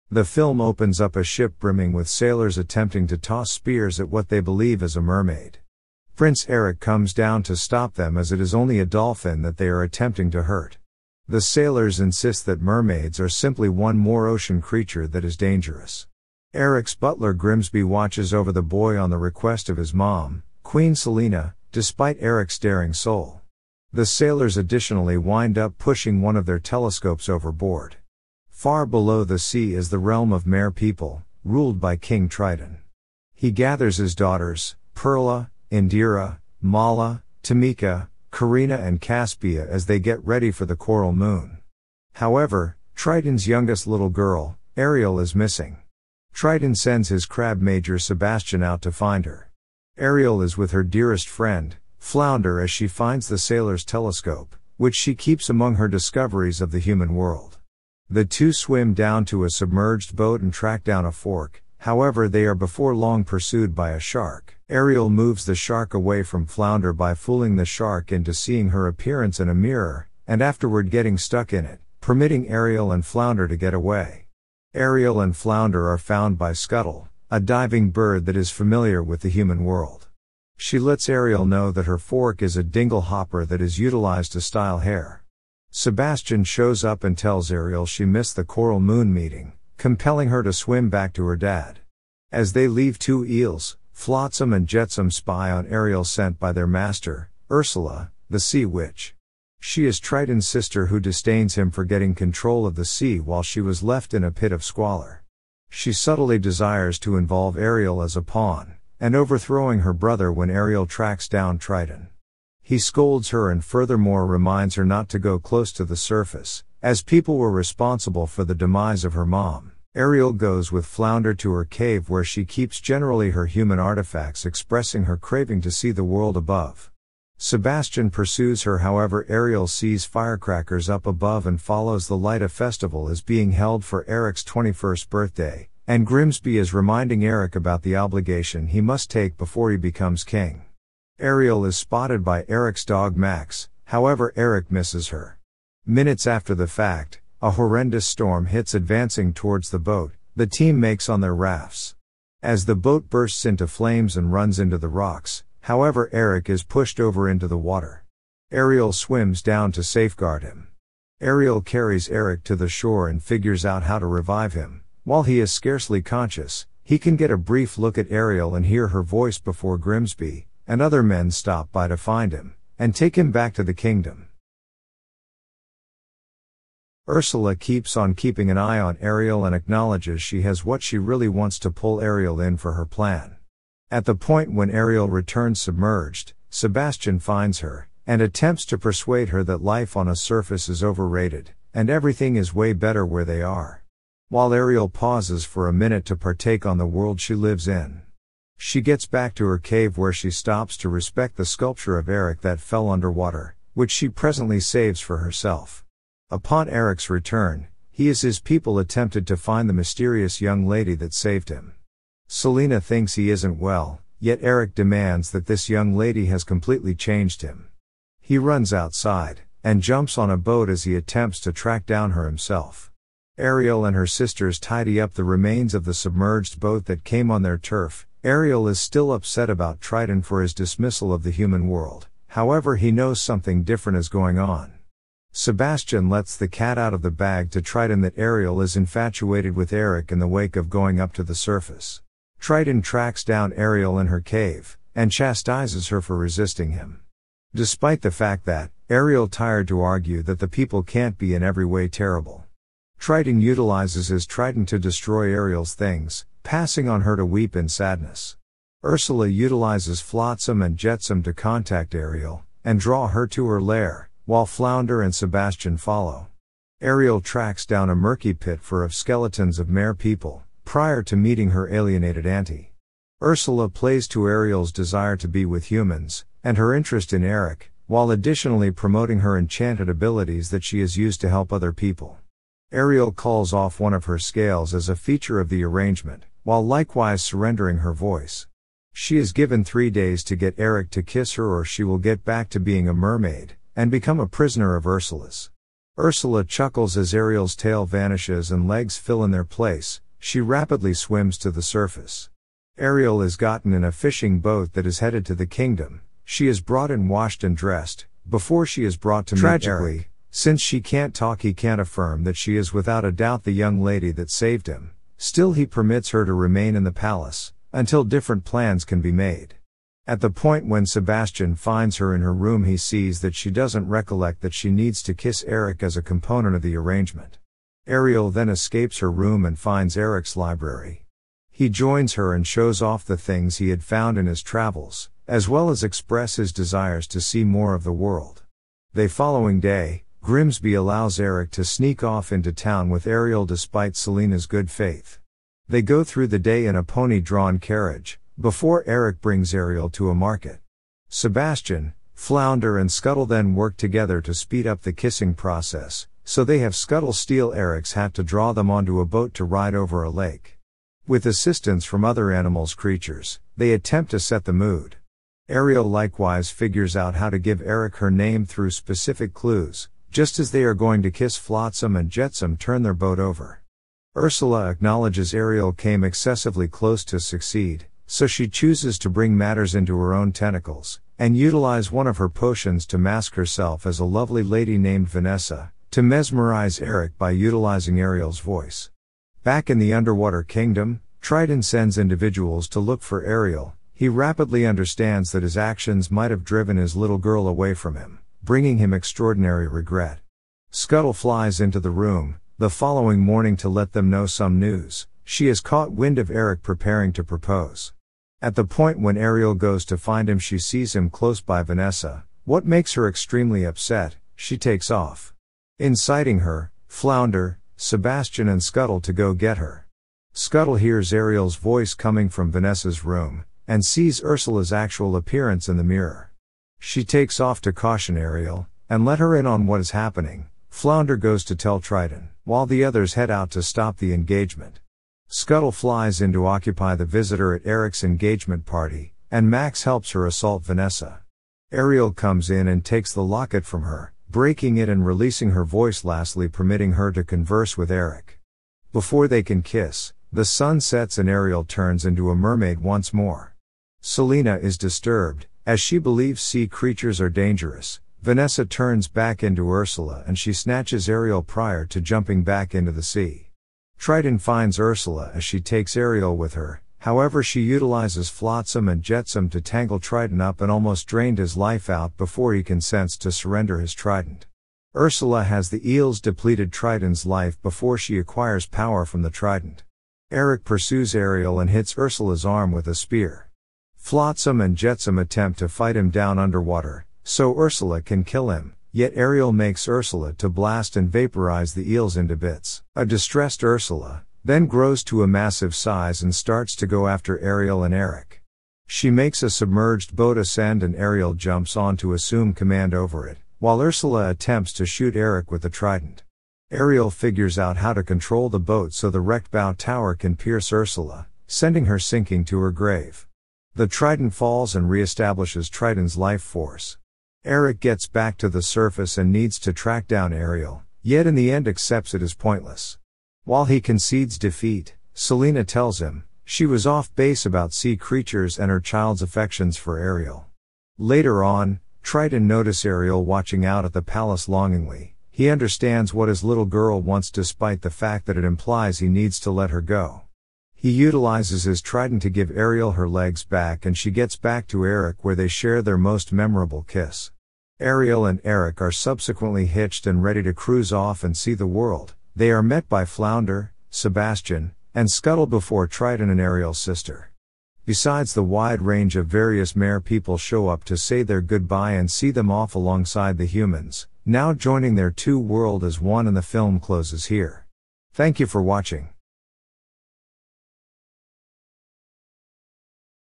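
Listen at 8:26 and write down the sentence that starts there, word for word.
Ariel figures out how to control the boat so the wrecked bow tower can pierce Ursula, sending her sinking to her grave.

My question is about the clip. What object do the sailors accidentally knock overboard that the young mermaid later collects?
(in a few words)
telescope.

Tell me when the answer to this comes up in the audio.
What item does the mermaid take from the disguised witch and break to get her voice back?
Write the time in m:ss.
7:23.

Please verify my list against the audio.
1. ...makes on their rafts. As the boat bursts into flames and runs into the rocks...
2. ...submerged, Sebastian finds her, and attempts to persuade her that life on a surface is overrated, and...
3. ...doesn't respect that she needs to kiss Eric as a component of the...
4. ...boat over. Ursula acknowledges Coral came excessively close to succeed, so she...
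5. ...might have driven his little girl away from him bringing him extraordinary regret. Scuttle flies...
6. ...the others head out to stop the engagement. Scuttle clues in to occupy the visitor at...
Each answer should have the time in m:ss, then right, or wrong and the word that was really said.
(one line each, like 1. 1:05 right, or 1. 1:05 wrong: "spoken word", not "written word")
1. 2:30 right
2. 3:05 right
3. 5:23 wrong: "recollect", not "respect"
4. 6:12 wrong: "Ariel", not "Coral"
5. 6:36 right
6. 7:12 wrong: "flies", not "clues".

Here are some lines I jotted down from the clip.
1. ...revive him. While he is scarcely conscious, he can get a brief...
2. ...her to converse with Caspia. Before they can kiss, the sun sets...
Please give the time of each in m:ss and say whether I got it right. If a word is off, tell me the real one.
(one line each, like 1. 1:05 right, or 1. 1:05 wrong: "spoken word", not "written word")
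1. 2:44 right
2. 7:26 wrong: "Eric", not "Caspia".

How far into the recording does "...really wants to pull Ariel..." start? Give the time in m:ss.
3:00.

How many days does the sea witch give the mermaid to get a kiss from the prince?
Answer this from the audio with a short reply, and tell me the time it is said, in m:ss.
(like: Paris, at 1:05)
3, at 4:49.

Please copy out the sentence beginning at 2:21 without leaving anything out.
Ariel is spotted by Eric's dog Max, however Eric misses her.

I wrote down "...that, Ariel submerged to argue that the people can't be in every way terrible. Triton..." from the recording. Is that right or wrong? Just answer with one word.
wrong.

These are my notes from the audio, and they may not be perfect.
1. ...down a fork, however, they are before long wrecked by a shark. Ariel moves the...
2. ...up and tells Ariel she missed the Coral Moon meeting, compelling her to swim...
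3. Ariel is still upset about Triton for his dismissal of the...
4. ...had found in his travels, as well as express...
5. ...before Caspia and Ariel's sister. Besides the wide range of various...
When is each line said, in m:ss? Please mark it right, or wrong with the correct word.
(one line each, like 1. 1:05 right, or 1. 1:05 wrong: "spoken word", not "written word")
1. 1:00 wrong: "pursued", not "wrecked"
2. 1:26 right
3. 3:48 right
4. 5:33 right
5. 9:15 wrong: "Triton", not "Caspia".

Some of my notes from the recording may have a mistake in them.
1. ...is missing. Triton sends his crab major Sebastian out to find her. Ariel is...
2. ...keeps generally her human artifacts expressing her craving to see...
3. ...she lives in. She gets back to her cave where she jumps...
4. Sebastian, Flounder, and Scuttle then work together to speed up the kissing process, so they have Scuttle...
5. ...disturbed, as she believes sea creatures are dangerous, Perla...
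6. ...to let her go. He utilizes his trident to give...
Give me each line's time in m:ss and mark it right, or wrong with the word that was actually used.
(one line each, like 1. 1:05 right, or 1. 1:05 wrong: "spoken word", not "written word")
1. 0:45 right
2. 2:02 right
3. 3:17 wrong: "stops", not "jumps"
4. 5:51 right
5. 7:34 wrong: "Vanessa", not "Perla"
6. 8:59 right.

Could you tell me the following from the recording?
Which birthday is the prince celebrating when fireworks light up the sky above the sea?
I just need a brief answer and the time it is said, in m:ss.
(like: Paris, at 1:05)
21st, at 2:14.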